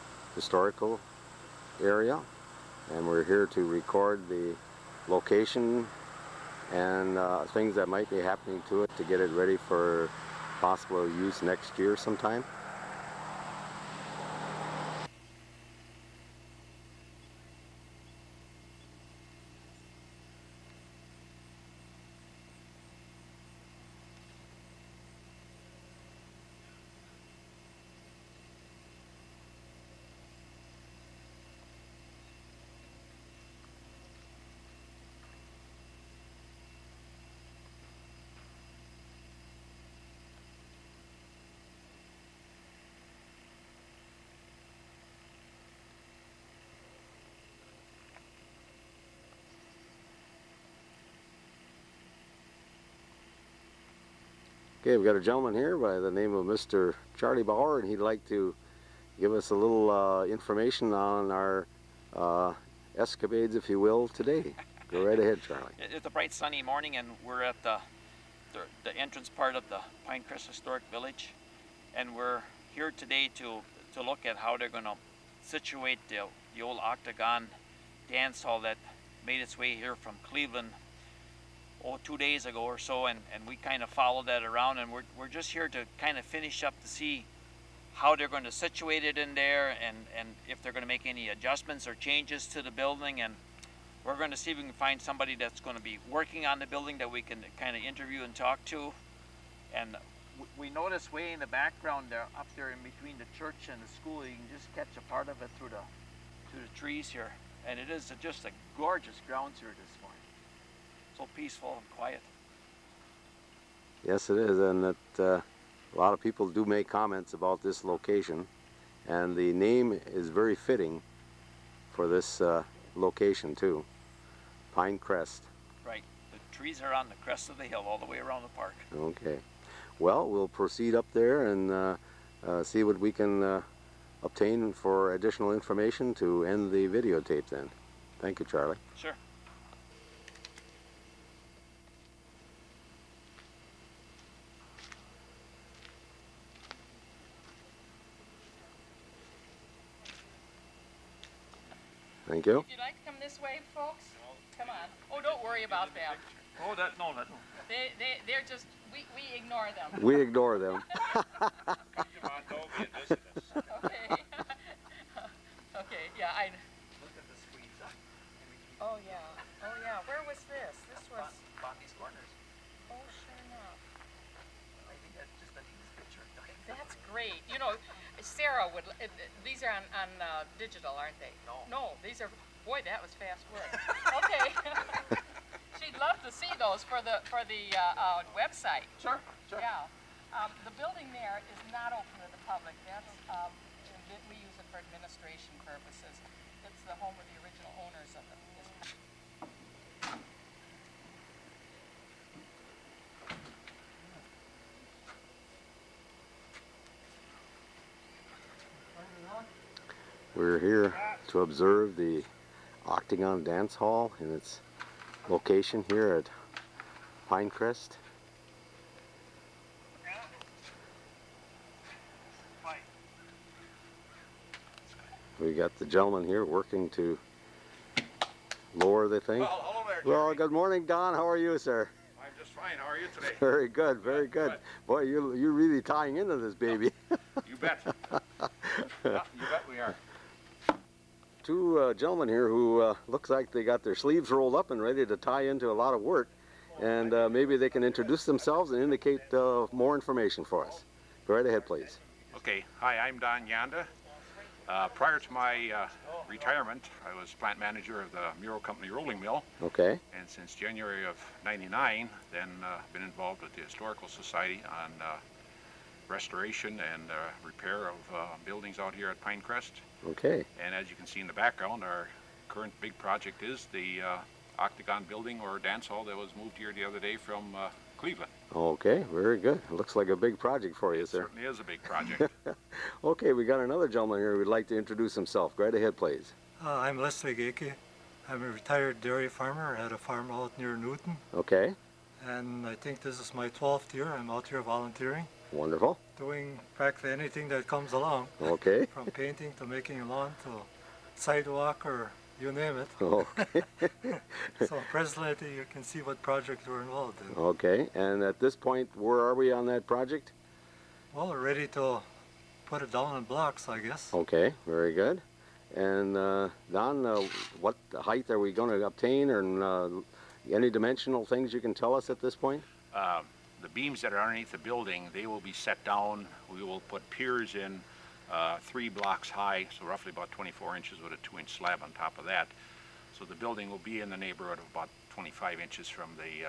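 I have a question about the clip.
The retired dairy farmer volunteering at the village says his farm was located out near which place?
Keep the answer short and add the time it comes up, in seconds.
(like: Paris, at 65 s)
Newton, at 290 s.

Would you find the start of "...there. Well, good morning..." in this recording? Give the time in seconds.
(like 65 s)
229 s.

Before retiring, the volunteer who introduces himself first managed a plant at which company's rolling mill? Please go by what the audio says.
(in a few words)
Mirro Company.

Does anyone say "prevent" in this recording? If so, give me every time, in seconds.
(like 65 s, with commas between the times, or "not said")
not said.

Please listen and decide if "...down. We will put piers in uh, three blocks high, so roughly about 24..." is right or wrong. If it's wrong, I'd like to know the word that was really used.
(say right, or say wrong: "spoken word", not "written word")
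right.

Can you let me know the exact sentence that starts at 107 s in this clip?
And it is just a gorgeous grounds here this peaceful and quiet.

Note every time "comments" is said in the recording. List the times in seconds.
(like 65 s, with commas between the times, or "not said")
116 s.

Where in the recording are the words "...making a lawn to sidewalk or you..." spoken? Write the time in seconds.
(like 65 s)
299 s.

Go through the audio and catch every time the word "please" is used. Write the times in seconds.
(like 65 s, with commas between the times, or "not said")
251 s, 285 s.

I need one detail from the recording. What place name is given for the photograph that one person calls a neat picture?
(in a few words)
Bondi's Corners.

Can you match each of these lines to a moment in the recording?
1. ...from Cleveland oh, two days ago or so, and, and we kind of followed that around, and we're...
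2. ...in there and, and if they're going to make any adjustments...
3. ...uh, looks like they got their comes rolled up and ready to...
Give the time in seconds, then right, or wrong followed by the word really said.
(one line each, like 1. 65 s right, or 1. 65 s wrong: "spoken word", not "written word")
1. 79 s right
2. 89 s right
3. 242 s wrong: "sleeves", not "comes".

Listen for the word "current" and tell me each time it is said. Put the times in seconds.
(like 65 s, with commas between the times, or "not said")
272 s.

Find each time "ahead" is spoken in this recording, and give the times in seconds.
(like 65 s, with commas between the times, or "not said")
65 s, 251 s, 285 s.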